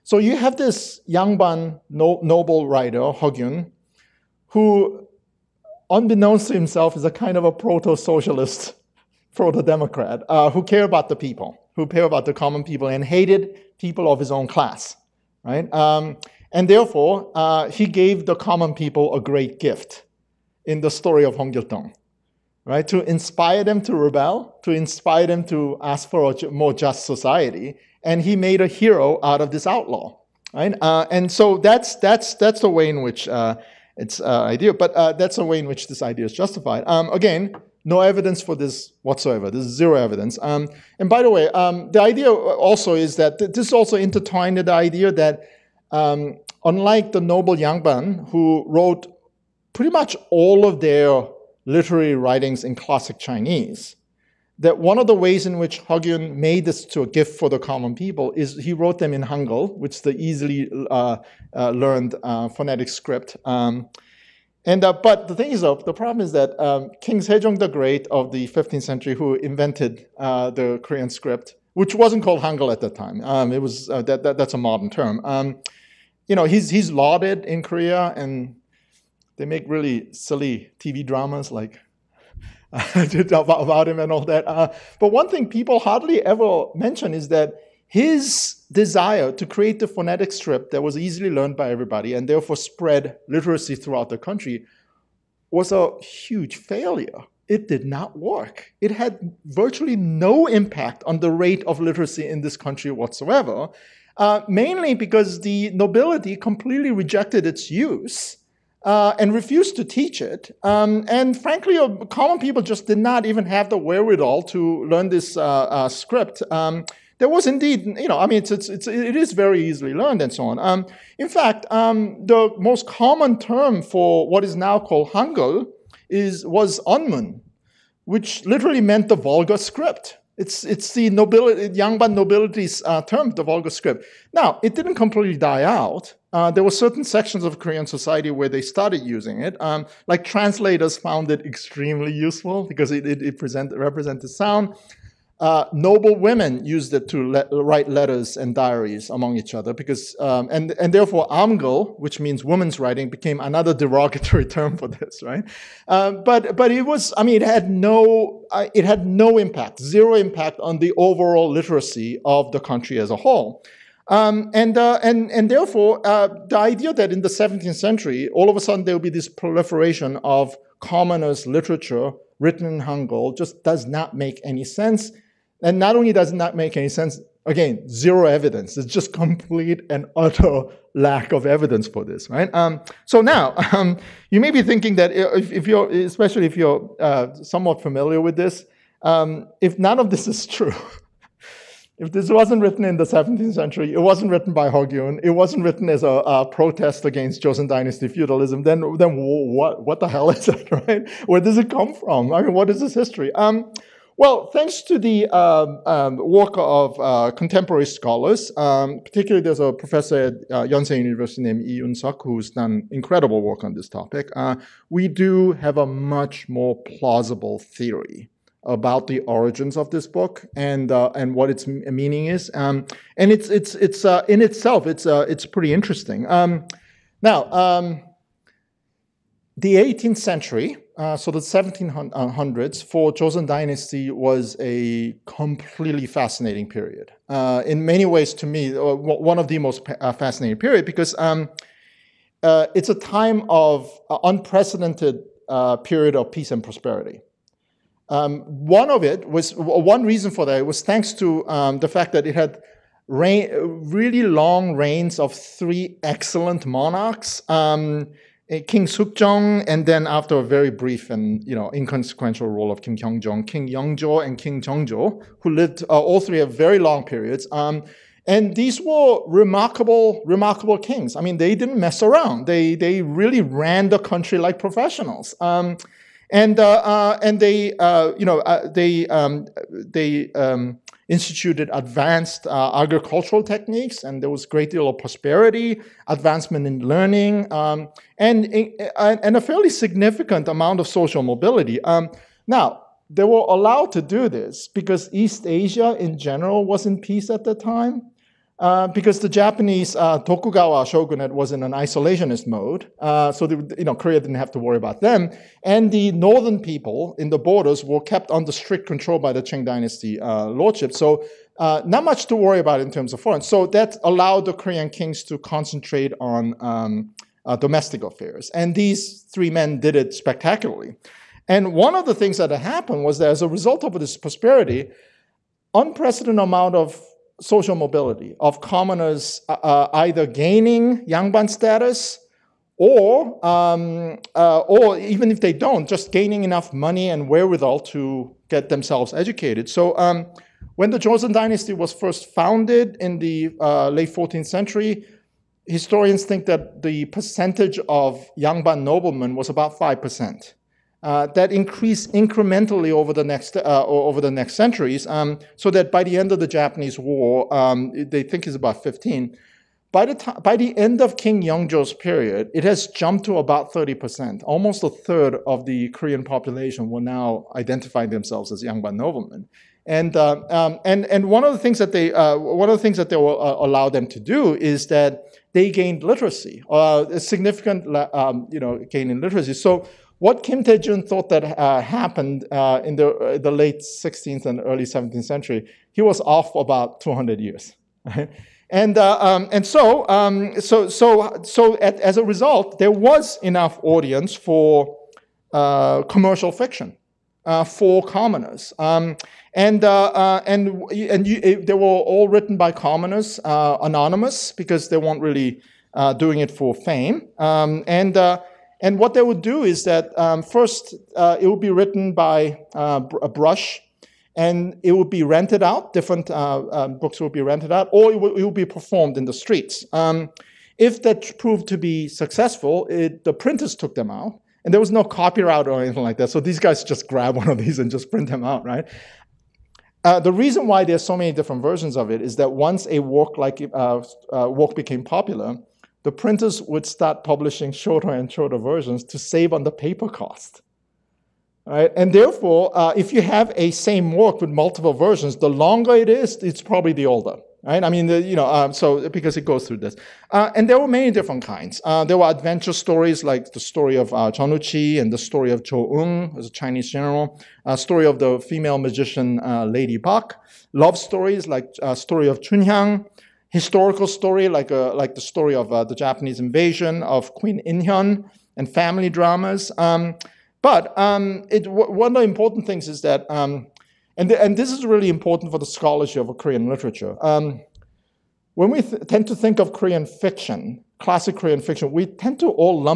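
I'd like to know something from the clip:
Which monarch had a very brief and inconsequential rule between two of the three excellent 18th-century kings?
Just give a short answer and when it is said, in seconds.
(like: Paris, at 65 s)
King Kyongjong, at 262 s.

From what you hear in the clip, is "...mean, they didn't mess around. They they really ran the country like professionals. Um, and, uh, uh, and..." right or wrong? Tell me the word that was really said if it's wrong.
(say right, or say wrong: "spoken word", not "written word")
right.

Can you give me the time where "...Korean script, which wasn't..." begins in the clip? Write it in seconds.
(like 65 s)
70 s.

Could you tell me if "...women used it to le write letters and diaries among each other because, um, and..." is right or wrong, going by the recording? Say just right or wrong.
right.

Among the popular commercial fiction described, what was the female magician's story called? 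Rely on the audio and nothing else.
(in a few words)
Lady Bach.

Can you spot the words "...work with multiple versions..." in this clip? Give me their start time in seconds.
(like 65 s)
444 s.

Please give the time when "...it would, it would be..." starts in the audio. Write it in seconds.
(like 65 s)
418 s.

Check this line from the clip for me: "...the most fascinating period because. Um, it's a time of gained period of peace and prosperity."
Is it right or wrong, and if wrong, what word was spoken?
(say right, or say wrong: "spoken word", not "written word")
wrong: "unprecedented", not "gained".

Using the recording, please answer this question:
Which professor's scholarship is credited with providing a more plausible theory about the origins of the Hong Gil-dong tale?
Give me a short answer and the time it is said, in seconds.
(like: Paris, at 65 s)
Lee Yun-suk, at 211 s.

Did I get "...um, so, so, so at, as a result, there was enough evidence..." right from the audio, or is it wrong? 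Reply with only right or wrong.
wrong.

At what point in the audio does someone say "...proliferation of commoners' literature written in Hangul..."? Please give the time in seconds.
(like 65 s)
169 s.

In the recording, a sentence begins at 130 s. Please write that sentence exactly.
It's, it's the nobility, Yangban nobility's uh, term, the vulgar script.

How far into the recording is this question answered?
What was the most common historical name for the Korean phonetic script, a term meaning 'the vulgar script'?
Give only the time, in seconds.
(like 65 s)
126 s.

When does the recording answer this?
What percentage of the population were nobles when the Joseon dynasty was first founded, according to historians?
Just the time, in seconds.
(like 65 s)
349 s.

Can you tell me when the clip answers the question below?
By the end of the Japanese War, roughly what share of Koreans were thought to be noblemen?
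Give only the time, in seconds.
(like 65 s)
358 s.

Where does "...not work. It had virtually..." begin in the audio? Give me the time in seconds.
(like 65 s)
97 s.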